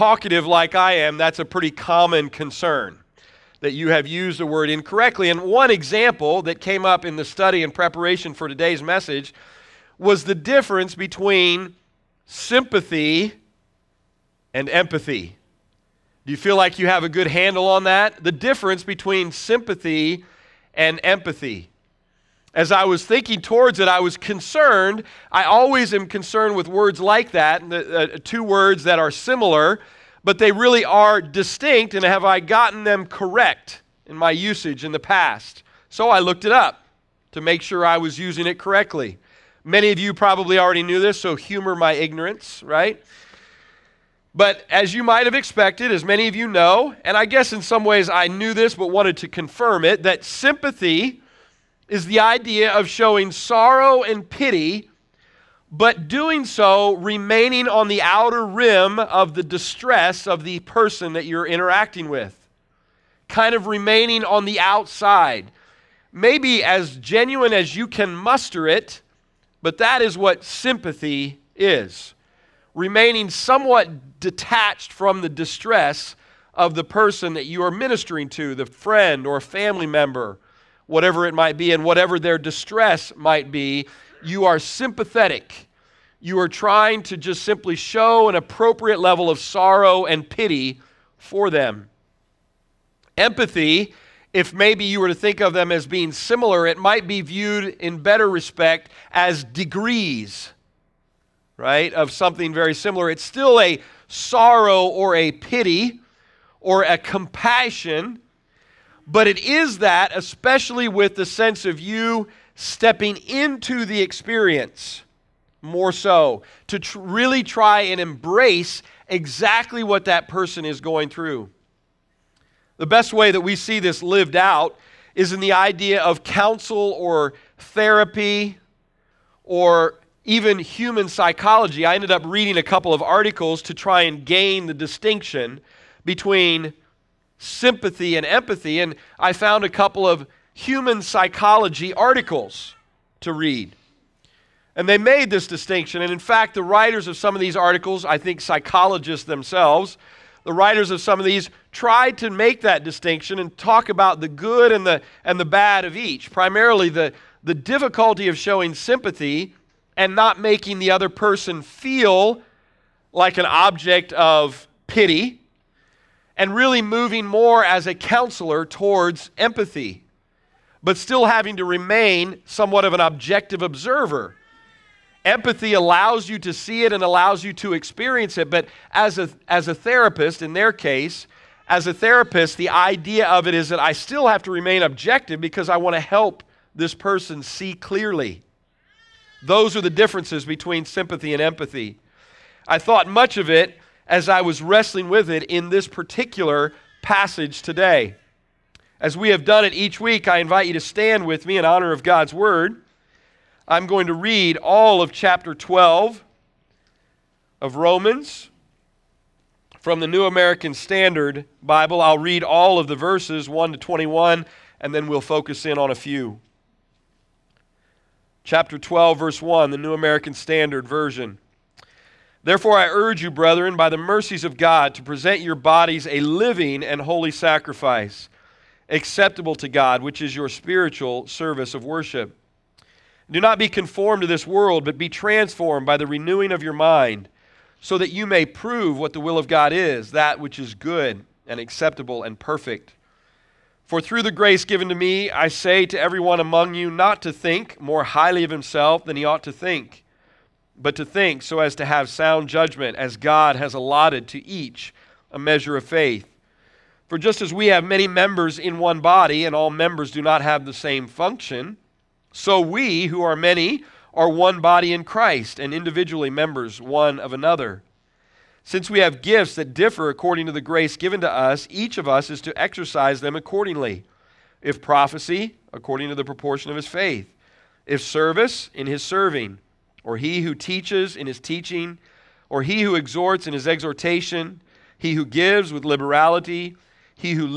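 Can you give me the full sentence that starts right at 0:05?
And one example that came up in the study in preparation for today's message was the difference between sympathy and empathy.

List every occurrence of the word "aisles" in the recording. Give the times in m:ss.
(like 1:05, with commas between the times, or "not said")
not said.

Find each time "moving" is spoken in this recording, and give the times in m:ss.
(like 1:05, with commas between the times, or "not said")
2:46.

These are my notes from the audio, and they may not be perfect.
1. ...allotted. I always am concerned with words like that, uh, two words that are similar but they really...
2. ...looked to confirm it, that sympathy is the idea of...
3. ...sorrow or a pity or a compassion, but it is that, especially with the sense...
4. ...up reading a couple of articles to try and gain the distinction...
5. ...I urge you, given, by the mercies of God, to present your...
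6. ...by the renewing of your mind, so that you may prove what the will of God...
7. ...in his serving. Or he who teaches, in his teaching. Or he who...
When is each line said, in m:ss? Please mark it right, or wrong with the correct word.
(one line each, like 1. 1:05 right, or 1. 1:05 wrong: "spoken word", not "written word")
1. 0:24 wrong: "concerned", not "allotted"
2. 0:48 wrong: "wanted", not "looked"
3. 1:44 right
4. 2:12 right
5. 3:42 wrong: "brethren", not "given"
6. 3:55 right
7. 4:38 right.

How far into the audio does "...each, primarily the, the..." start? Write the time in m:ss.
2:35.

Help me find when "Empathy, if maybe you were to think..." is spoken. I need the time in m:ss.
1:33.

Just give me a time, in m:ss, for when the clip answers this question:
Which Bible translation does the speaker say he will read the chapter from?
3:30.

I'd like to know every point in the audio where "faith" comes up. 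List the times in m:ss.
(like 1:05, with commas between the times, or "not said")
4:15, 4:36.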